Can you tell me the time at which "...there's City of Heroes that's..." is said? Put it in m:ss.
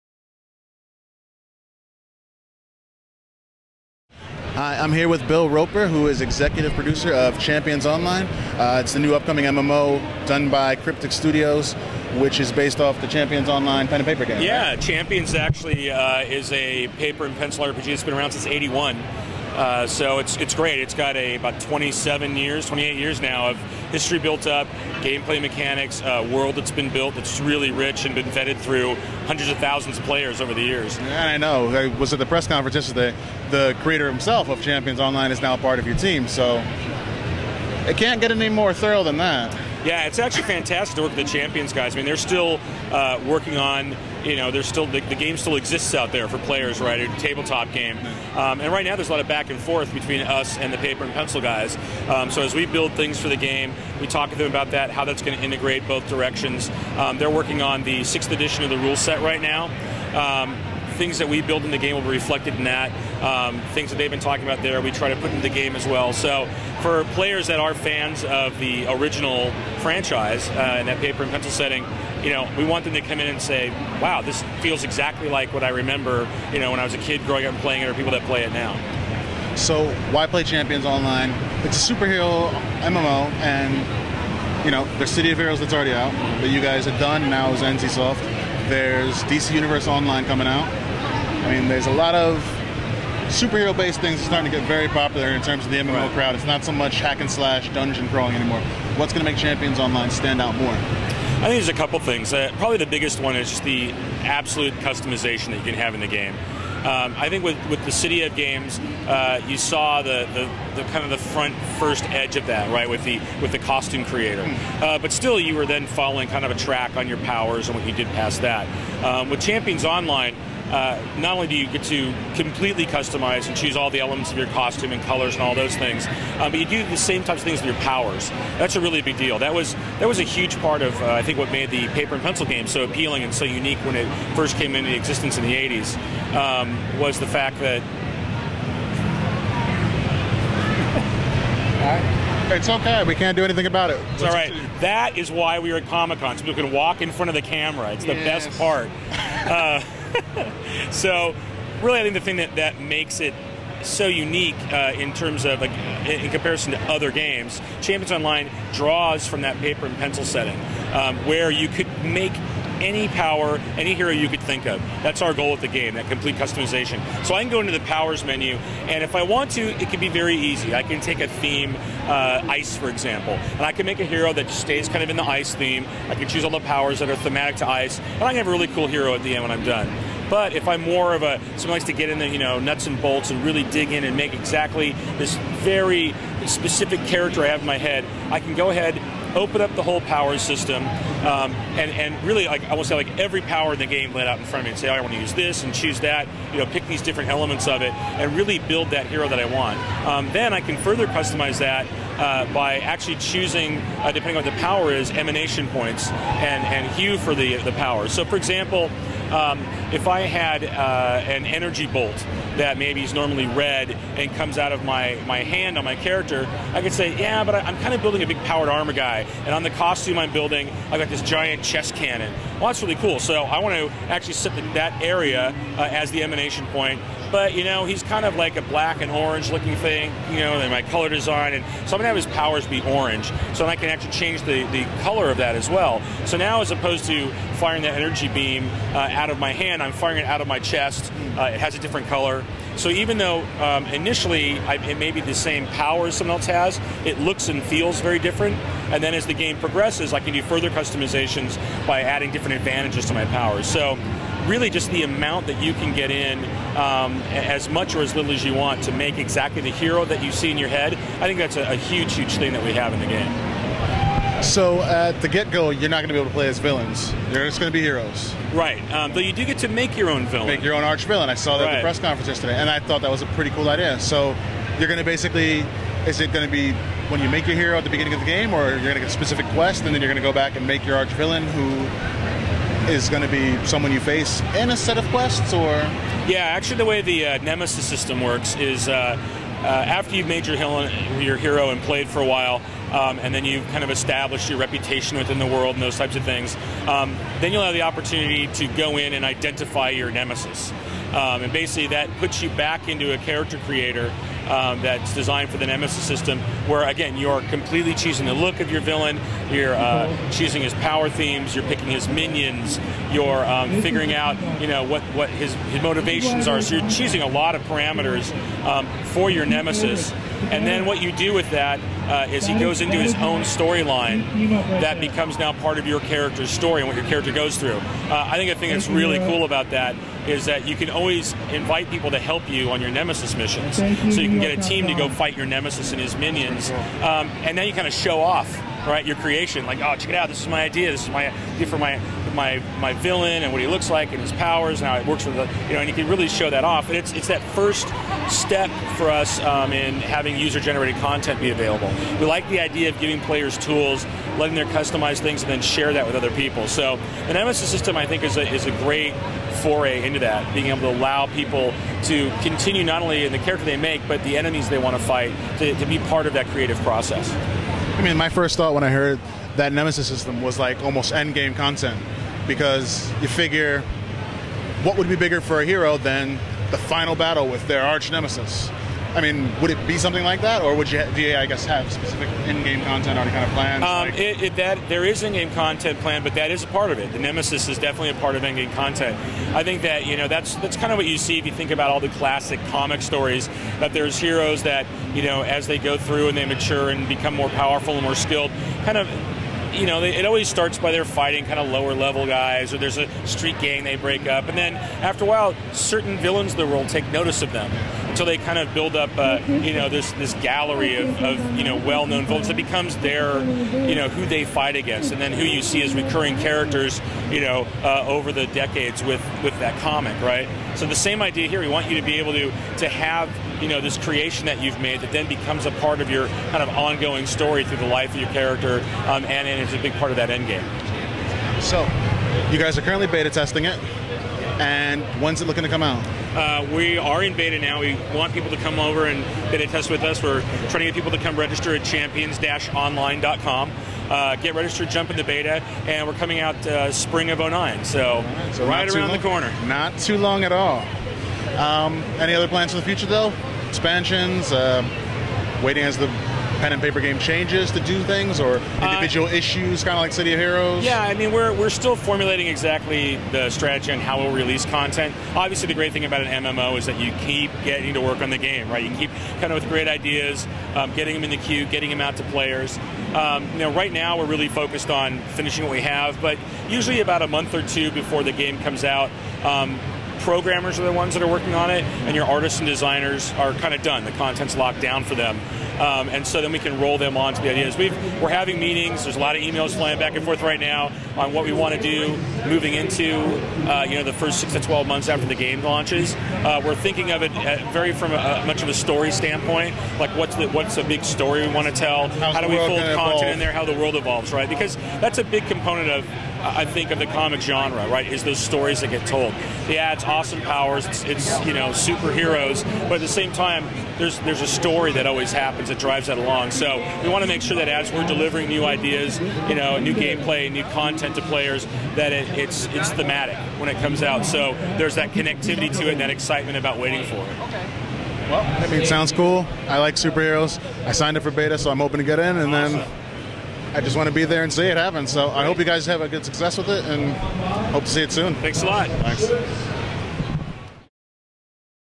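1:24.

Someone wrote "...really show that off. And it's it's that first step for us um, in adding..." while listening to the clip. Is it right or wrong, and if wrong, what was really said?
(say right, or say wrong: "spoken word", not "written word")
wrong: "having", not "adding".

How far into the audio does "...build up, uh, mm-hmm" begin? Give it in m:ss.
6:48.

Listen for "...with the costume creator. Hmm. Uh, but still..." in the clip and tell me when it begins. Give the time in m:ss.
1:53.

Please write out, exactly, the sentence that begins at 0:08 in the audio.
Uh, it's the new upcoming MMO done by Cryptic Studios, which is based off the Champions Online pen and paper game.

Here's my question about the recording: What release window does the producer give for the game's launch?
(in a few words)
spring of 2009.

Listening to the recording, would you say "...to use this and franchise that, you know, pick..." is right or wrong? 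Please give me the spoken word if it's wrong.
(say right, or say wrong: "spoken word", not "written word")
wrong: "choose", not "franchise".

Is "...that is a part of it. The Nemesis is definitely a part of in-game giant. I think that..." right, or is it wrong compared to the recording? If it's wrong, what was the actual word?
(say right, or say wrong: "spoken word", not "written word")
wrong: "content", not "giant".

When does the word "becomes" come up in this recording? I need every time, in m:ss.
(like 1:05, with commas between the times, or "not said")
5:24, 6:37, 6:52, 7:05.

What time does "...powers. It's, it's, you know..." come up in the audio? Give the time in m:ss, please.
8:30.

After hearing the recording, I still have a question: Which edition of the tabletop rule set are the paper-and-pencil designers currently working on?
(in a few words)
sixth.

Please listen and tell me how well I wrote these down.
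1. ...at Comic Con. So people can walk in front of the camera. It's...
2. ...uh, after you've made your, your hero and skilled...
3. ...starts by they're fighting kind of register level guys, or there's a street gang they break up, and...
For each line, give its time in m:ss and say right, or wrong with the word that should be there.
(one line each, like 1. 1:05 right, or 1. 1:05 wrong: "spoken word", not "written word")
1. 2:25 right
2. 4:49 wrong: "played", not "skilled"
3. 6:40 wrong: "lower", not "register".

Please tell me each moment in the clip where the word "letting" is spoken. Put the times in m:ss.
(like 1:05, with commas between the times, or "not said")
5:54.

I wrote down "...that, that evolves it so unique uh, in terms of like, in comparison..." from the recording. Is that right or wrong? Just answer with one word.
wrong.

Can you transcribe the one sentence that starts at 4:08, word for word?
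And then as the game progresses, I can do further customizations by adding different advantages to my powers.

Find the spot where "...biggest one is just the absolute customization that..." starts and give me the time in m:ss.
1:42.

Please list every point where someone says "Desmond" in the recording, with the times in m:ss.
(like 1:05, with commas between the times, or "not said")
not said.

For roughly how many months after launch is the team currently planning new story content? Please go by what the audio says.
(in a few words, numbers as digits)
6 to 12 months.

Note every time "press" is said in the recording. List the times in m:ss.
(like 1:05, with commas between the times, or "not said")
0:32, 4:31.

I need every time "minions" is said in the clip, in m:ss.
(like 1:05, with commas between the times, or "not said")
5:12, 5:36.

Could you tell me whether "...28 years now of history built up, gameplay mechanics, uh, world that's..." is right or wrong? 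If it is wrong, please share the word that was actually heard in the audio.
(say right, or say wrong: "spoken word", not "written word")
right.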